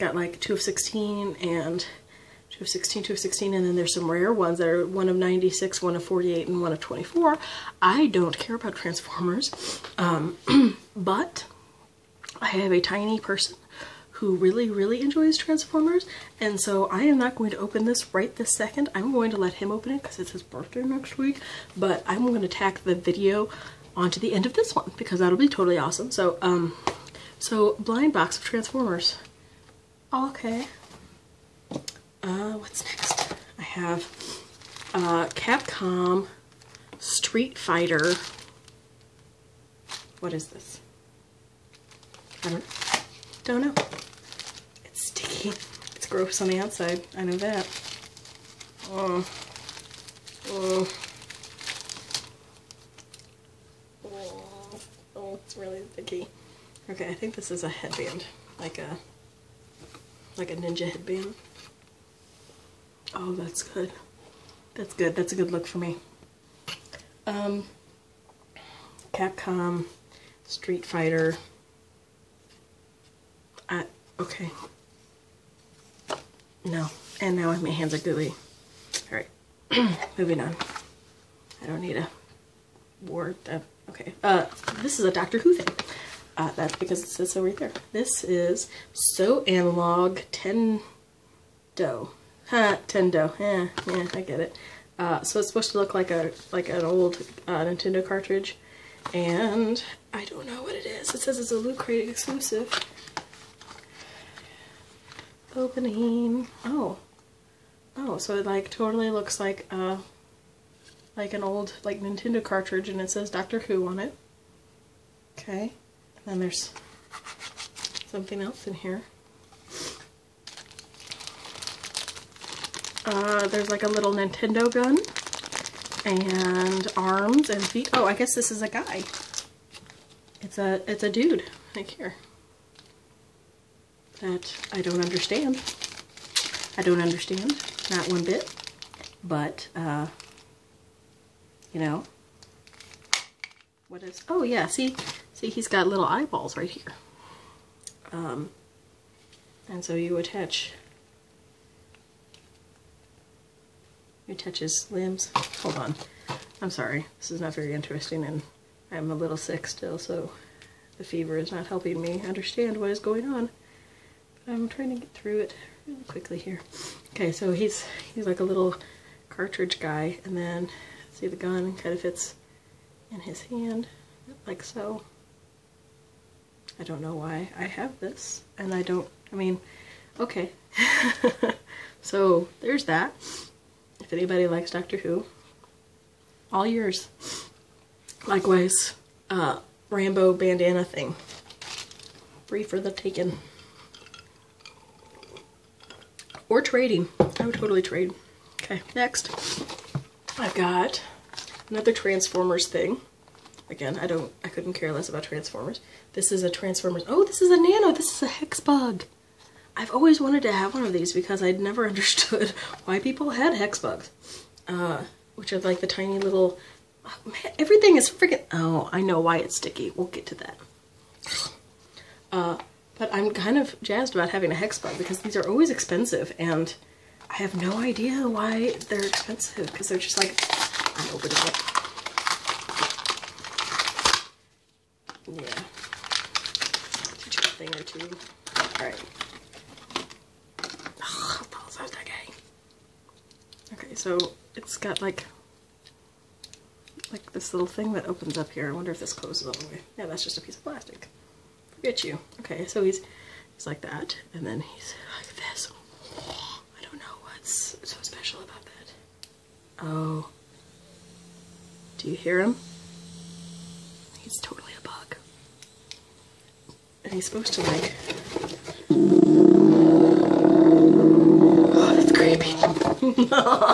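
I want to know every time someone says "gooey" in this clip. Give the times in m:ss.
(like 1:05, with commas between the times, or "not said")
1:17.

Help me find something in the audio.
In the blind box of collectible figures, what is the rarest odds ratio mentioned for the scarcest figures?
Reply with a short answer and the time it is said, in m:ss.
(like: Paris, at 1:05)
1 of 96, at 0:04.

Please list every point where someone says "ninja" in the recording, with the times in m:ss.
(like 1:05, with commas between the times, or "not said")
1:00.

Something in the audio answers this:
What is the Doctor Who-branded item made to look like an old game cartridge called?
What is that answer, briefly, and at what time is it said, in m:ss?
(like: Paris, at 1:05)
So Analog Tendo, at 1:28.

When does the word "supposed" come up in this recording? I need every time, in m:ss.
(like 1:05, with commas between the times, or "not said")
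1:35, 4:27.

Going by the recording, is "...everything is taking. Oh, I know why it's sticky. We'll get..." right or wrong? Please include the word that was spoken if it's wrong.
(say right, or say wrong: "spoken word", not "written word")
wrong: "freaking", not "taking".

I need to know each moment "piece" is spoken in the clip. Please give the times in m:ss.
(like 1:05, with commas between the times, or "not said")
4:10.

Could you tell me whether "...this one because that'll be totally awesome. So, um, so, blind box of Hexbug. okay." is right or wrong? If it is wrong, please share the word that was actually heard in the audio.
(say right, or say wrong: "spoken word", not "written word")
wrong: "Transformers", not "Hexbug".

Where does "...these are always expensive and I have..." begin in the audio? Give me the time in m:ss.
3:45.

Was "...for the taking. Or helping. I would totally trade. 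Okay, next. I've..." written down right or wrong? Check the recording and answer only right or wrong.
wrong.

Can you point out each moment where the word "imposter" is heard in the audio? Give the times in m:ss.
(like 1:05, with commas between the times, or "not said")
not said.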